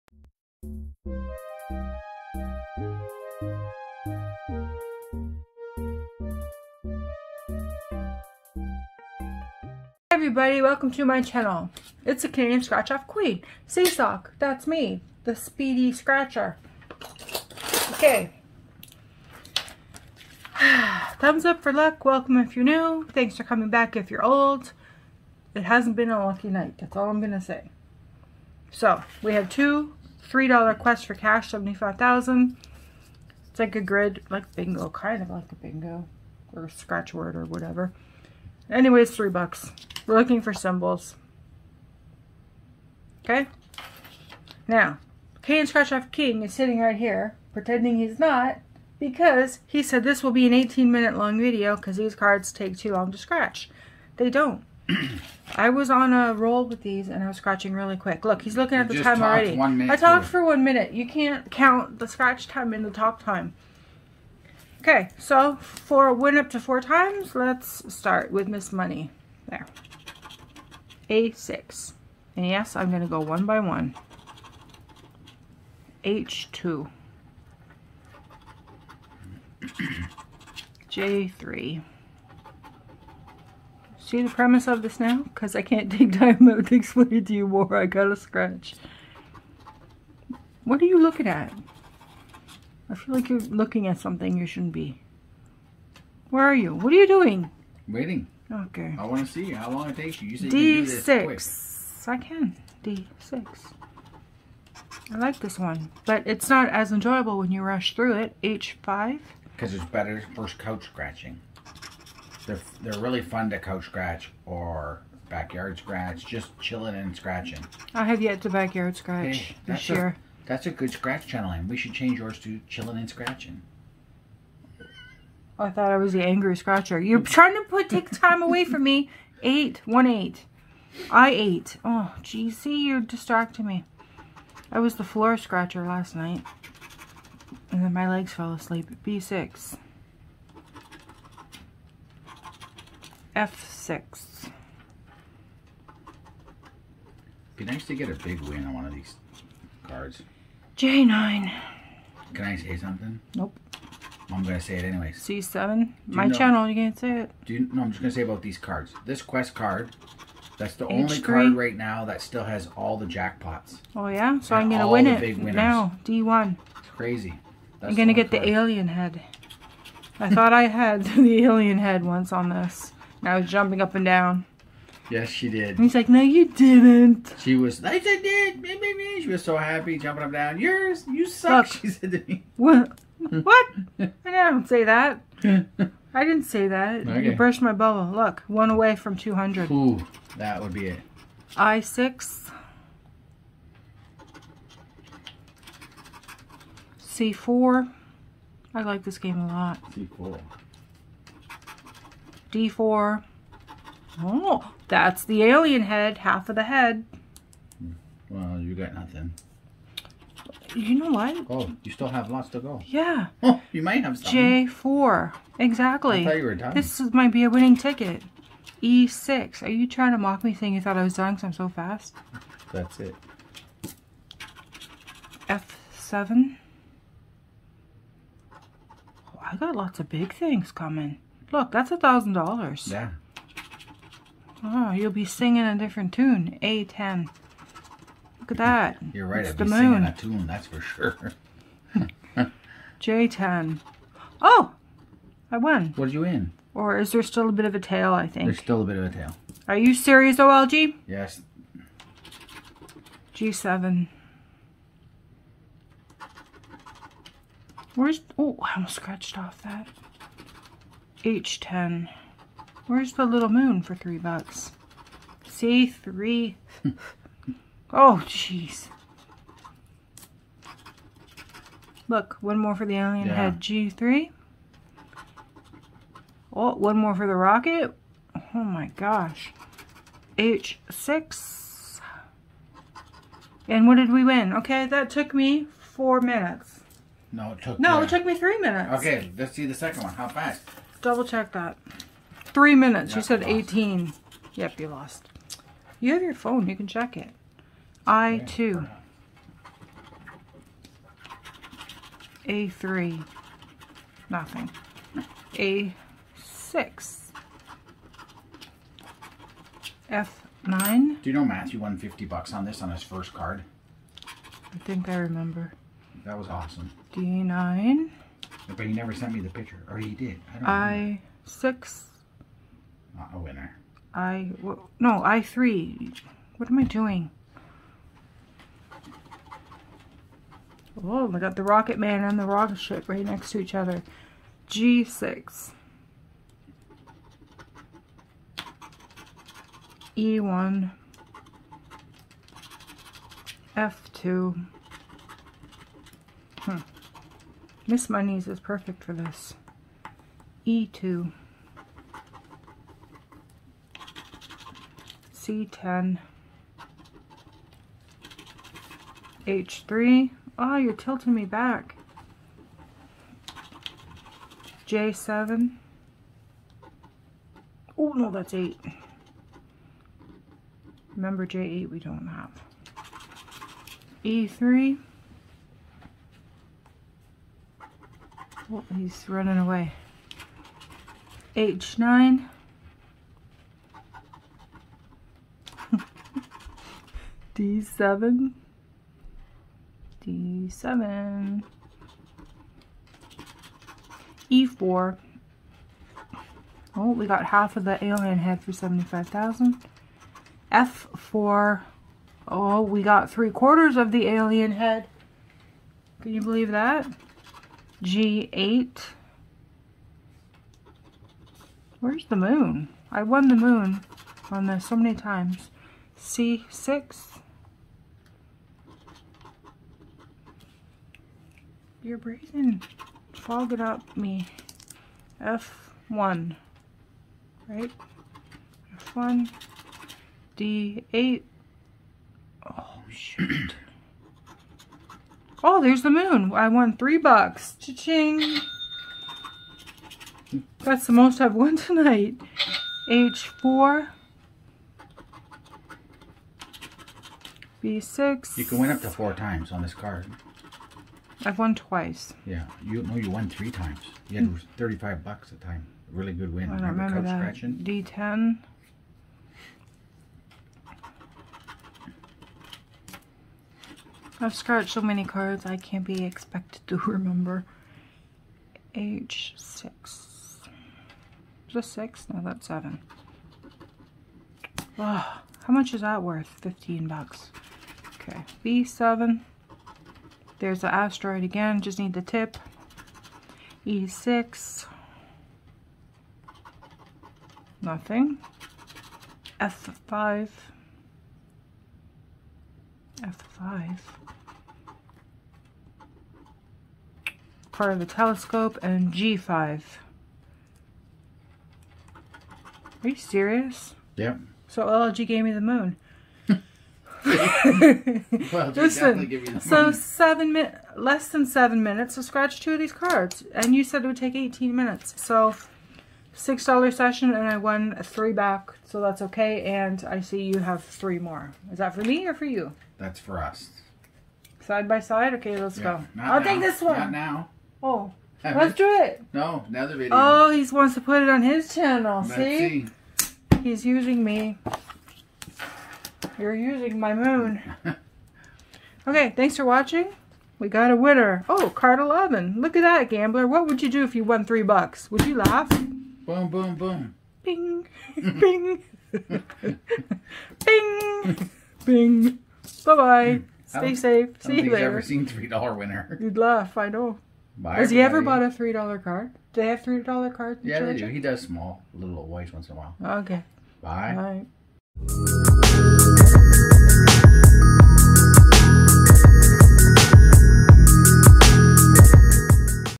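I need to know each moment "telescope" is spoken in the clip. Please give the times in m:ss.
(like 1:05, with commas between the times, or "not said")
8:18.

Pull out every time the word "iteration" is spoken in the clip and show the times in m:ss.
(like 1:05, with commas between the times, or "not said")
not said.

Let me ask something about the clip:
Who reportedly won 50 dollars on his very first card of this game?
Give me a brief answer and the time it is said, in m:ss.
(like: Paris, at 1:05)
Matthew, at 5:11.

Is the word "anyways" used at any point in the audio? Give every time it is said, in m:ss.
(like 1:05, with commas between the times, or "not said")
0:38, 2:34.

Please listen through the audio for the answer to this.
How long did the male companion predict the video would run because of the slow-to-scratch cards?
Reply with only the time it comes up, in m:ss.
0:50.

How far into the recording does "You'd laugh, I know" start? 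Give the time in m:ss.
9:16.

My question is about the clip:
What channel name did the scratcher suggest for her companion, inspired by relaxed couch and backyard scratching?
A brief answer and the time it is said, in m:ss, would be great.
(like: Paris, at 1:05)
Chillin' and scratching, at 2:02.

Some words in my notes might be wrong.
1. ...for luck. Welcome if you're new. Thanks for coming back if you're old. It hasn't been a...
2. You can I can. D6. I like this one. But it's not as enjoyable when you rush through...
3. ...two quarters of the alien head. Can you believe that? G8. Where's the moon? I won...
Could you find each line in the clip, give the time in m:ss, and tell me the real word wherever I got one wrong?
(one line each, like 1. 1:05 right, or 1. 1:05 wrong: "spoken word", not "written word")
1. 0:21 right
2. 1:42 right
3. 6:43 wrong: "three", not "two".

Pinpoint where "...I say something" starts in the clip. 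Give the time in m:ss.
2:32.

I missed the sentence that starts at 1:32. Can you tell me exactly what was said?
I feel like you're looking at something you shouldn't be.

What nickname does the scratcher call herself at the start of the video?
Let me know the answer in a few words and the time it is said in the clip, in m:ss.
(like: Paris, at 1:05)
the Speedy Scratcher, at 0:15.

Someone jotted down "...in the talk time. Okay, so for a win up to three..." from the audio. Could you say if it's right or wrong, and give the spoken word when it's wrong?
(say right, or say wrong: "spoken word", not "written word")
wrong: "four", not "three".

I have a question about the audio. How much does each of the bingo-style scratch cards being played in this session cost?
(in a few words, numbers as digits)
$3.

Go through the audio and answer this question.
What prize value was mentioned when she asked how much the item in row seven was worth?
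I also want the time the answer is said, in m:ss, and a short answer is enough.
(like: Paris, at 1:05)
$15, at 7:56.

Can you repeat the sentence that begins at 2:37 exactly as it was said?
Do you, no, I'm just gonna say about these cards.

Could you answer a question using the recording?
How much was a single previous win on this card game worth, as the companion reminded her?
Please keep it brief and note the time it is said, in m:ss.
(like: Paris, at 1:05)
$35, at 7:34.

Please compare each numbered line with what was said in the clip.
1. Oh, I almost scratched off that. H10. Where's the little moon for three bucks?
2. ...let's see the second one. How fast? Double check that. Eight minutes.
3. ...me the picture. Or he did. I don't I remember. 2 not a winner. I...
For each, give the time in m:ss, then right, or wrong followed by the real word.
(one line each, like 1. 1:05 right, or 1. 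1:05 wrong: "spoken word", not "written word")
1. 4:18 right
2. 4:49 wrong: "Three", not "Eight"
3. 5:19 wrong: "6", not "2".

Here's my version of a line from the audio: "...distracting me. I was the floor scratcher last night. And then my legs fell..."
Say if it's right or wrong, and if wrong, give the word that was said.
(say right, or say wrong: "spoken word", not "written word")
right.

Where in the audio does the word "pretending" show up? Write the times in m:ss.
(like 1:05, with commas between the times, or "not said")
0:47.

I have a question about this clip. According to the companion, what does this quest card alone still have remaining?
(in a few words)
all the jackpots.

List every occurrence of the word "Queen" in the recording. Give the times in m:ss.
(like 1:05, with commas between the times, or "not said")
0:13.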